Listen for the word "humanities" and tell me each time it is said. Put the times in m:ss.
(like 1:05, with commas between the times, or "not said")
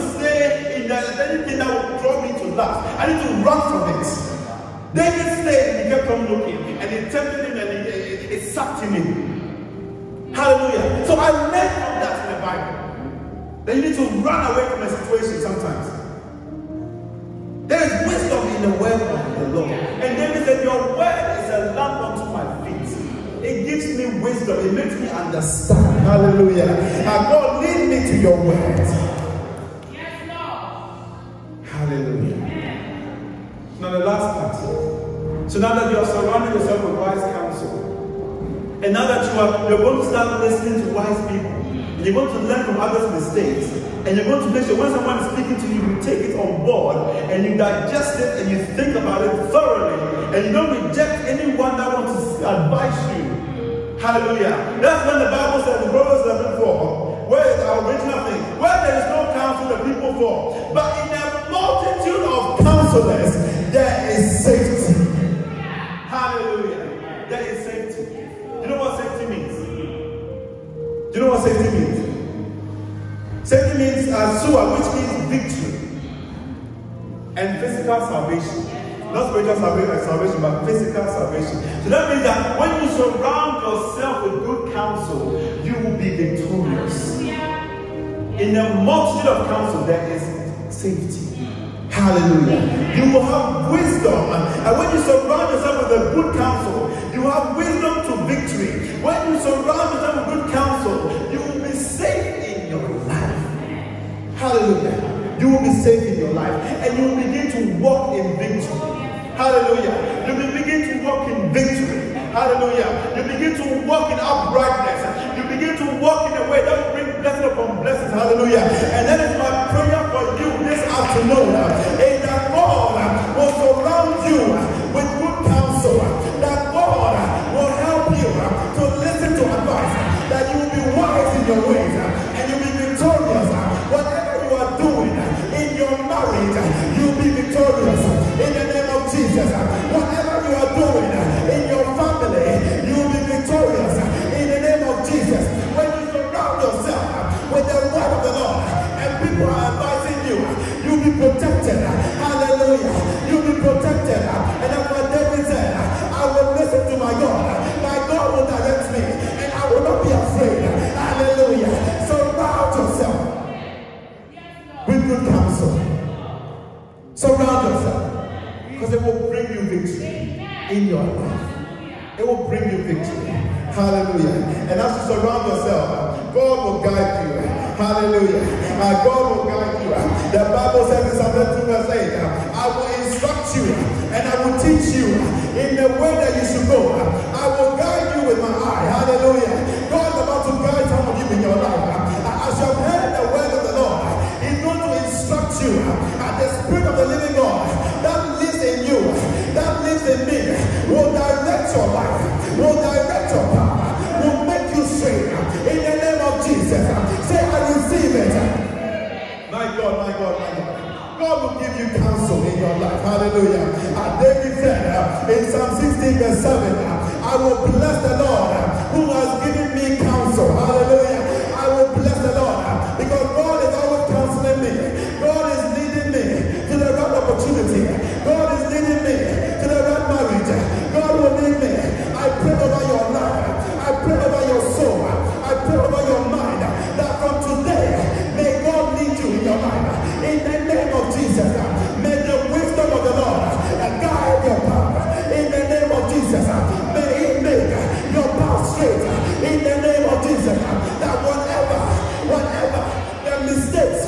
not said.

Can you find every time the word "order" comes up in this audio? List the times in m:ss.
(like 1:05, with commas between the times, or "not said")
3:14.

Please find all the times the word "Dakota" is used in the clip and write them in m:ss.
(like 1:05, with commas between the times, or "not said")
not said.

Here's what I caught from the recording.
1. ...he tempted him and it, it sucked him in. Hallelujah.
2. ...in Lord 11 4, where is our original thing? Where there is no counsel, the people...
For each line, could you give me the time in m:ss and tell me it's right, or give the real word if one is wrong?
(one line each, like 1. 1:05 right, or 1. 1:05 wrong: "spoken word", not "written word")
1. 0:06 right
2. 0:55 wrong: "Proverbs", not "Lord".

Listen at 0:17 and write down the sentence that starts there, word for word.
There is wisdom in the word of the Lord.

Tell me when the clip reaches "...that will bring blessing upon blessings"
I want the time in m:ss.
1:56.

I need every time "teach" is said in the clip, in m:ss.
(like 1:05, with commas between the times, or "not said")
3:04.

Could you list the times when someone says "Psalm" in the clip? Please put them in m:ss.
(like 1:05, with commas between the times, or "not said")
3:01, 3:35.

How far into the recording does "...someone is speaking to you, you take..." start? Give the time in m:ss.
0:44.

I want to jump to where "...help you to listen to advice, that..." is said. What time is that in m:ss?
2:07.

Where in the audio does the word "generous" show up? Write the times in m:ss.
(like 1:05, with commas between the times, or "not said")
not said.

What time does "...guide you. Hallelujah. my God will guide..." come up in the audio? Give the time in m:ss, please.
2:56.